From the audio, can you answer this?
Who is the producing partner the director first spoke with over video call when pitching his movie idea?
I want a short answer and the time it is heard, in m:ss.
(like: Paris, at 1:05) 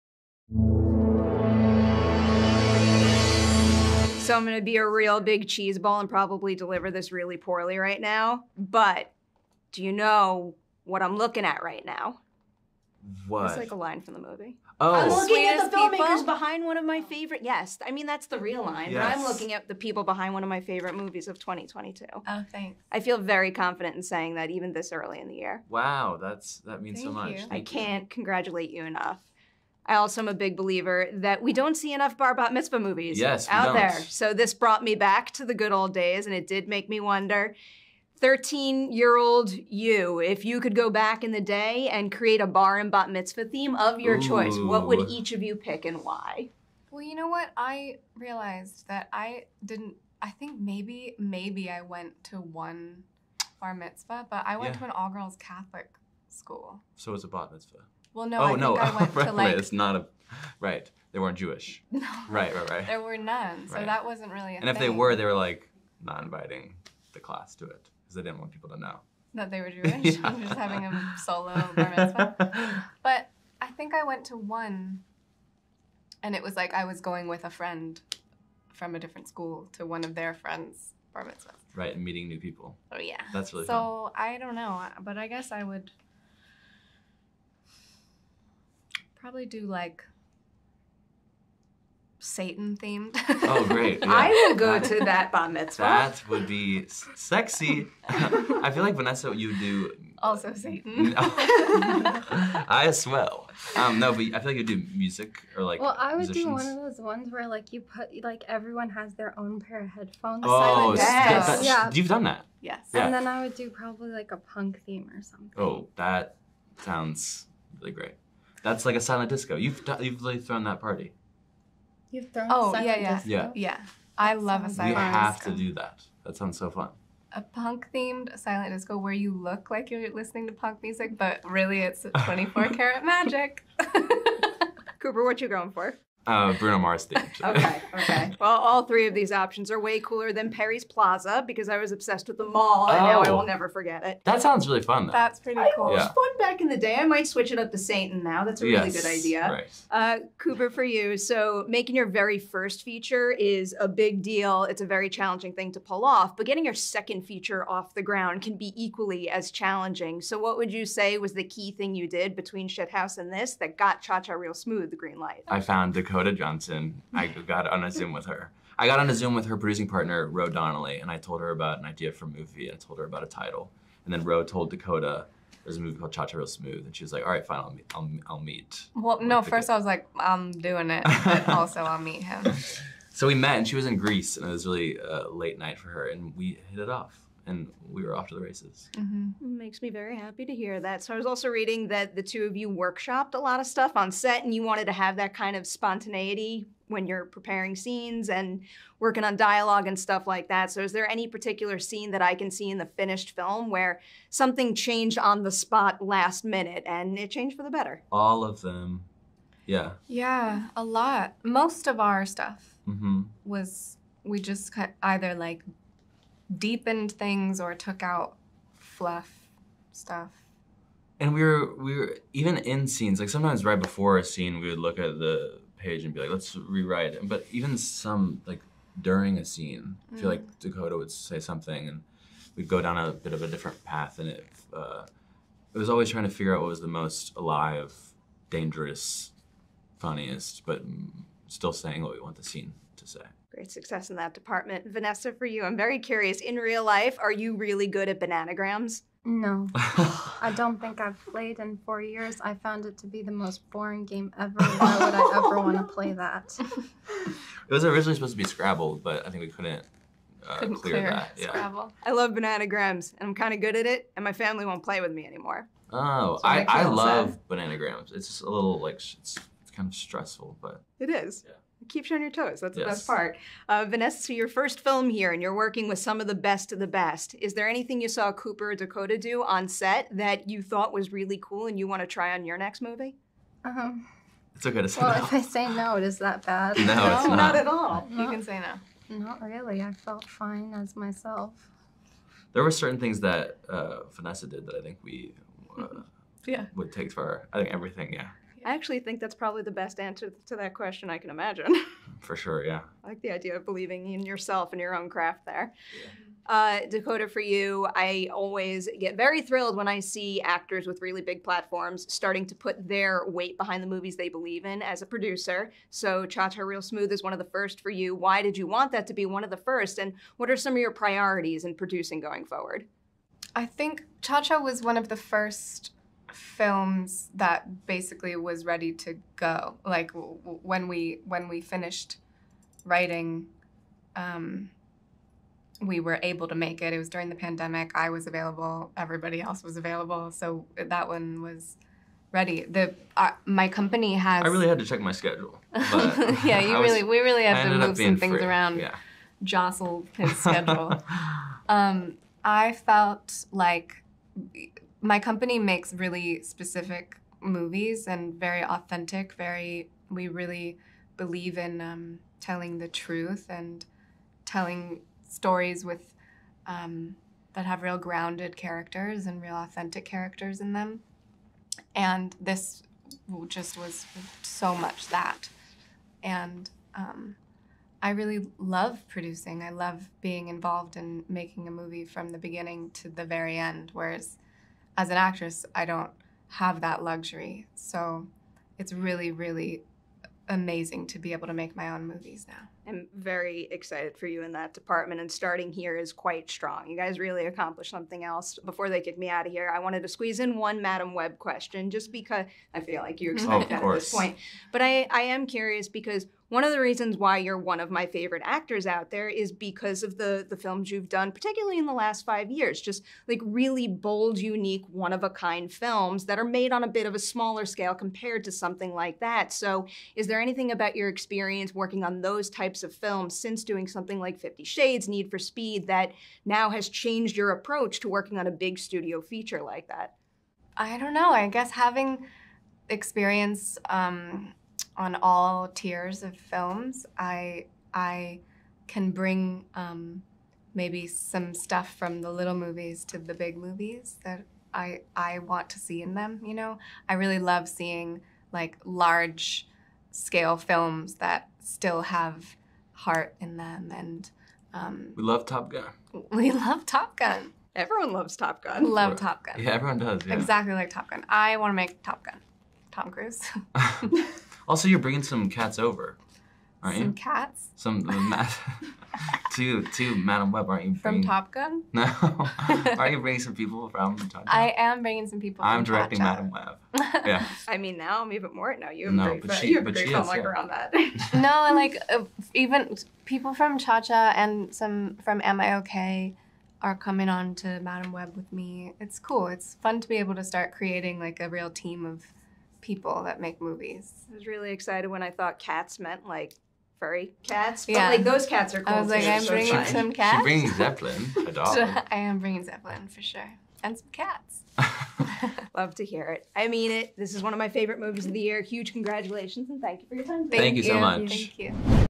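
Ro Donnelly, at 2:50.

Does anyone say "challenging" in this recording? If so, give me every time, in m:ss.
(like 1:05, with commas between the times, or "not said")
2:35, 2:39.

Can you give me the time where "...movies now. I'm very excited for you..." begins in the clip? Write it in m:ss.
6:32.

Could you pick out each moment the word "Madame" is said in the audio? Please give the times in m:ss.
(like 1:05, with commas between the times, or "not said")
6:40, 7:50, 7:56, 8:07.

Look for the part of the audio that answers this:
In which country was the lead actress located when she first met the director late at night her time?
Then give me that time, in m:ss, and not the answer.
3:03.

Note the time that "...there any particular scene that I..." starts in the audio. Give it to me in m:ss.
3:20.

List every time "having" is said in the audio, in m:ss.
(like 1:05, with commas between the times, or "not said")
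1:10, 7:11.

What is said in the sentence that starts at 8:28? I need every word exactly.
Huge congratulations and thank you for your time.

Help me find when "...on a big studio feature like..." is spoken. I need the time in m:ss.
7:08.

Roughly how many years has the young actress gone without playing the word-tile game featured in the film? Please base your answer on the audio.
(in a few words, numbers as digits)
4.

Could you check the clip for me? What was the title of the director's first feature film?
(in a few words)
Shithouse.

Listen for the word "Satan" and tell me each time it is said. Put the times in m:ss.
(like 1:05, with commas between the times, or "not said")
1:32, 1:40, 2:27.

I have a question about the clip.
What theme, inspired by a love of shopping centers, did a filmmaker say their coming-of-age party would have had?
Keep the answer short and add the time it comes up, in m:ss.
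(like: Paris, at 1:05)
Perry's Plaza, at 2:20.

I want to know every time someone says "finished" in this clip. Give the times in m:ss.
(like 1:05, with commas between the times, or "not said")
3:22, 5:31.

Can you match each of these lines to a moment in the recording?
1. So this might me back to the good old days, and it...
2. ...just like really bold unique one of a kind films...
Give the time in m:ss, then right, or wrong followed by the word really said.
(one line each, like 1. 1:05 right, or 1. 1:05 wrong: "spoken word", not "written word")
1. 0:34 wrong: "brought", not "might"
2. 6:52 right.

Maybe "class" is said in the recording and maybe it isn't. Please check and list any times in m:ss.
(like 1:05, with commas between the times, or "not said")
1:07.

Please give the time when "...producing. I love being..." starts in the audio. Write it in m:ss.
6:19.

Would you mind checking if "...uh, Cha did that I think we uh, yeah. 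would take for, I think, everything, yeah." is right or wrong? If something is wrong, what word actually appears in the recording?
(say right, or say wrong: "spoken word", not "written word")
wrong: "Vanessa", not "Cha".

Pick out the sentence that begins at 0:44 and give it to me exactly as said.
choice, what would each of you pick and why?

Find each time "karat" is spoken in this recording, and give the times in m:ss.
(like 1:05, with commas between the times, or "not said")
2:12.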